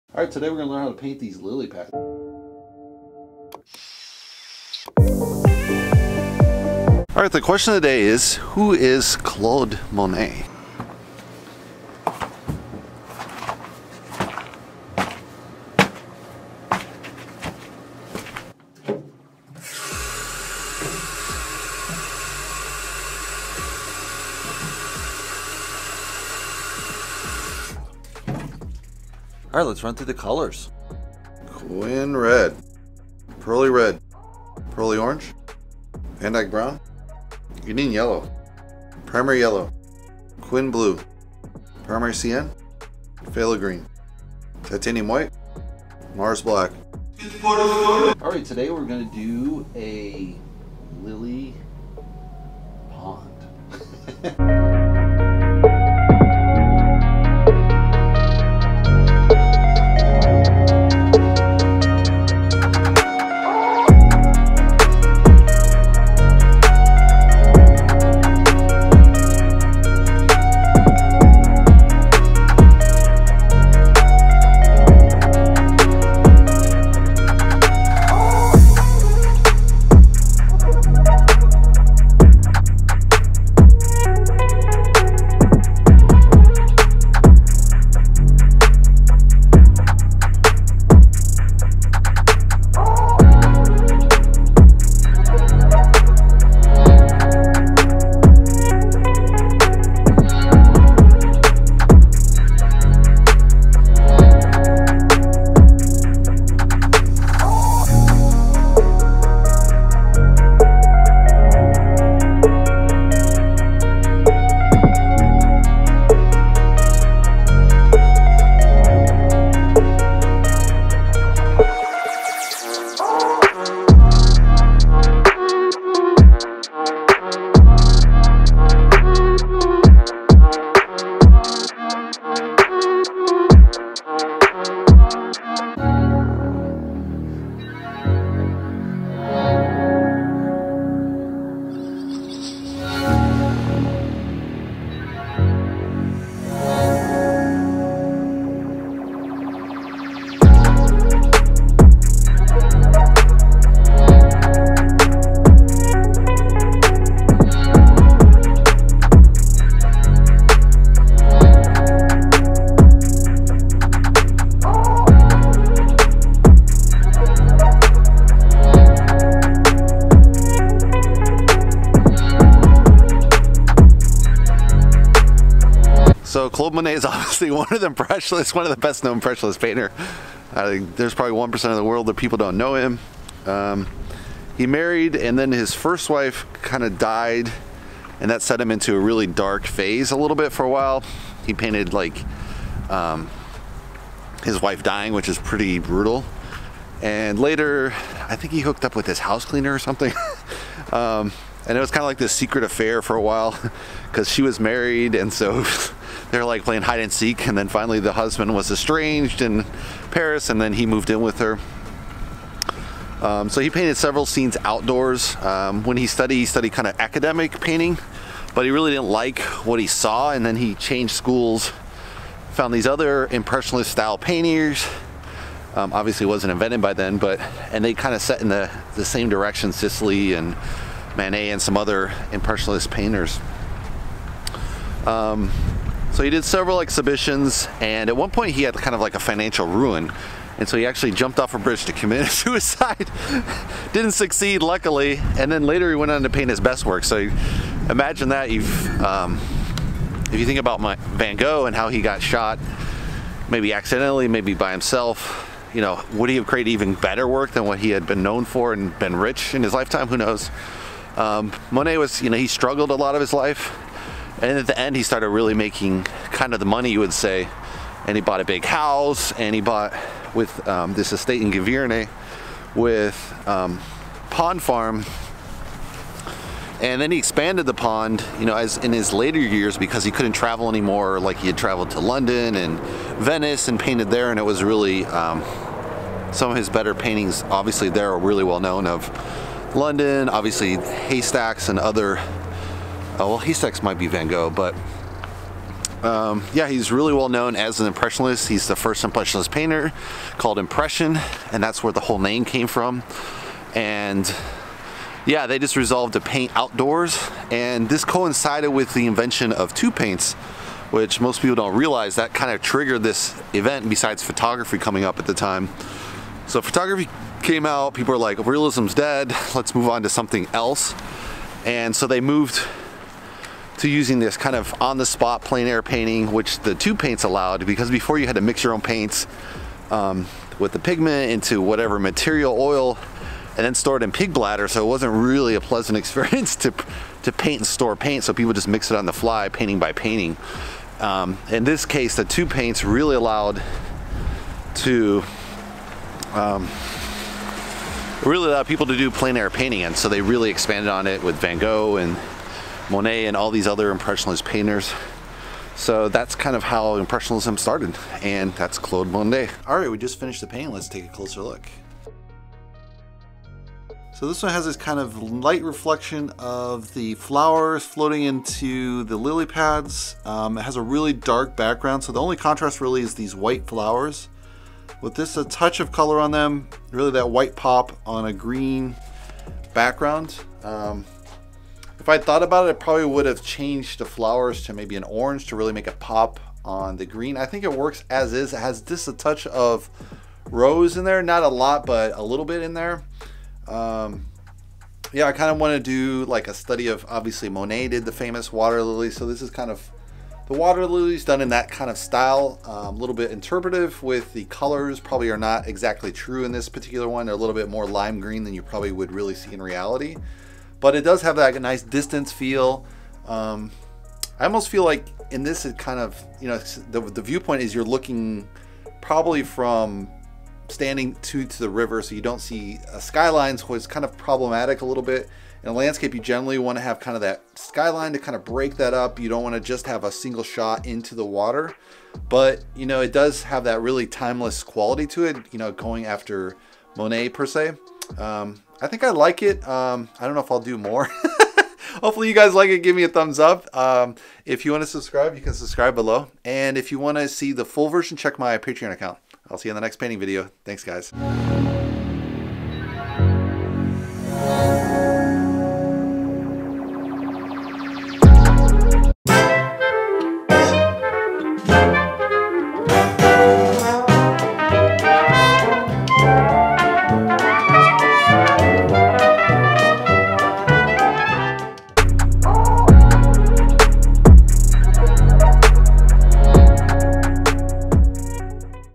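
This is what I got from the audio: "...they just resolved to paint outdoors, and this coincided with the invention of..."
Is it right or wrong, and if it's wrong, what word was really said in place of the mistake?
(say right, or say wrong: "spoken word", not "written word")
right.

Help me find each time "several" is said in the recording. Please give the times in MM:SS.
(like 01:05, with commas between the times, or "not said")
03:33, 03:56.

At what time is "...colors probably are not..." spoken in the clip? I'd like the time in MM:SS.
06:44.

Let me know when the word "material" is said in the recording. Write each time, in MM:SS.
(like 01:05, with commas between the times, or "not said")
05:31.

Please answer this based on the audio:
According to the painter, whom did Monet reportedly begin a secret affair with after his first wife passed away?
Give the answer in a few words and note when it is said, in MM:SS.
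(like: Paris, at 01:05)
His house cleaner, at 03:19.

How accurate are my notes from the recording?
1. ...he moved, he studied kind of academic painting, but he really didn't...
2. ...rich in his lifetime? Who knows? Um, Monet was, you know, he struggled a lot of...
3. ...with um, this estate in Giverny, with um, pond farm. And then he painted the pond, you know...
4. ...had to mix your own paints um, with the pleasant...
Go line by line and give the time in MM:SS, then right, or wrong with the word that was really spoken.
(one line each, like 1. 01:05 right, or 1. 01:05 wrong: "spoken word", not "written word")
1. 03:35 wrong: "studied", not "moved"
2. 04:19 right
3. 04:30 wrong: "expanded", not "painted"
4. 05:28 wrong: "pigment", not "pleasant".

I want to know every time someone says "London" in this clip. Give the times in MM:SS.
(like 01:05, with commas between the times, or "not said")
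04:41, 04:49.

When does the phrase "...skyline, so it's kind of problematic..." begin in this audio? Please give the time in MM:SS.
07:02.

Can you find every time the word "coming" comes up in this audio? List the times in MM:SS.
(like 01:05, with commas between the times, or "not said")
05:14.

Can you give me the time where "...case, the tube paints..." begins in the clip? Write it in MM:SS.
05:41.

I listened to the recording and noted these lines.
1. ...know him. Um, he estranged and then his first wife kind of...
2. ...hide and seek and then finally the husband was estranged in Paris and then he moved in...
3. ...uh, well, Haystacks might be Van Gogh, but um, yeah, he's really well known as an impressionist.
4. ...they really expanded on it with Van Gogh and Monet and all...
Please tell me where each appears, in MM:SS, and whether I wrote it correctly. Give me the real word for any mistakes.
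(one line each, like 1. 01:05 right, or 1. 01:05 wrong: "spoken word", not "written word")
1. 03:02 wrong: "married", not "estranged"
2. 03:26 right
3. 04:53 right
4. 05:50 right.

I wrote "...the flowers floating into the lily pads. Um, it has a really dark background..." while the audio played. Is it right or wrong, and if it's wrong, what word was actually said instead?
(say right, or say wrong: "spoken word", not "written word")
right.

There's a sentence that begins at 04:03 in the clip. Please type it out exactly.
Didn't succeed, luckily, and then later he went on to paint his best work.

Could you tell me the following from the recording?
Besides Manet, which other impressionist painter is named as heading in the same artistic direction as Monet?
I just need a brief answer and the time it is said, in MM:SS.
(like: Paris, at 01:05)
Sisley, at 03:49.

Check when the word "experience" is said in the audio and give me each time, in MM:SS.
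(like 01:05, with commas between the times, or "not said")
05:35.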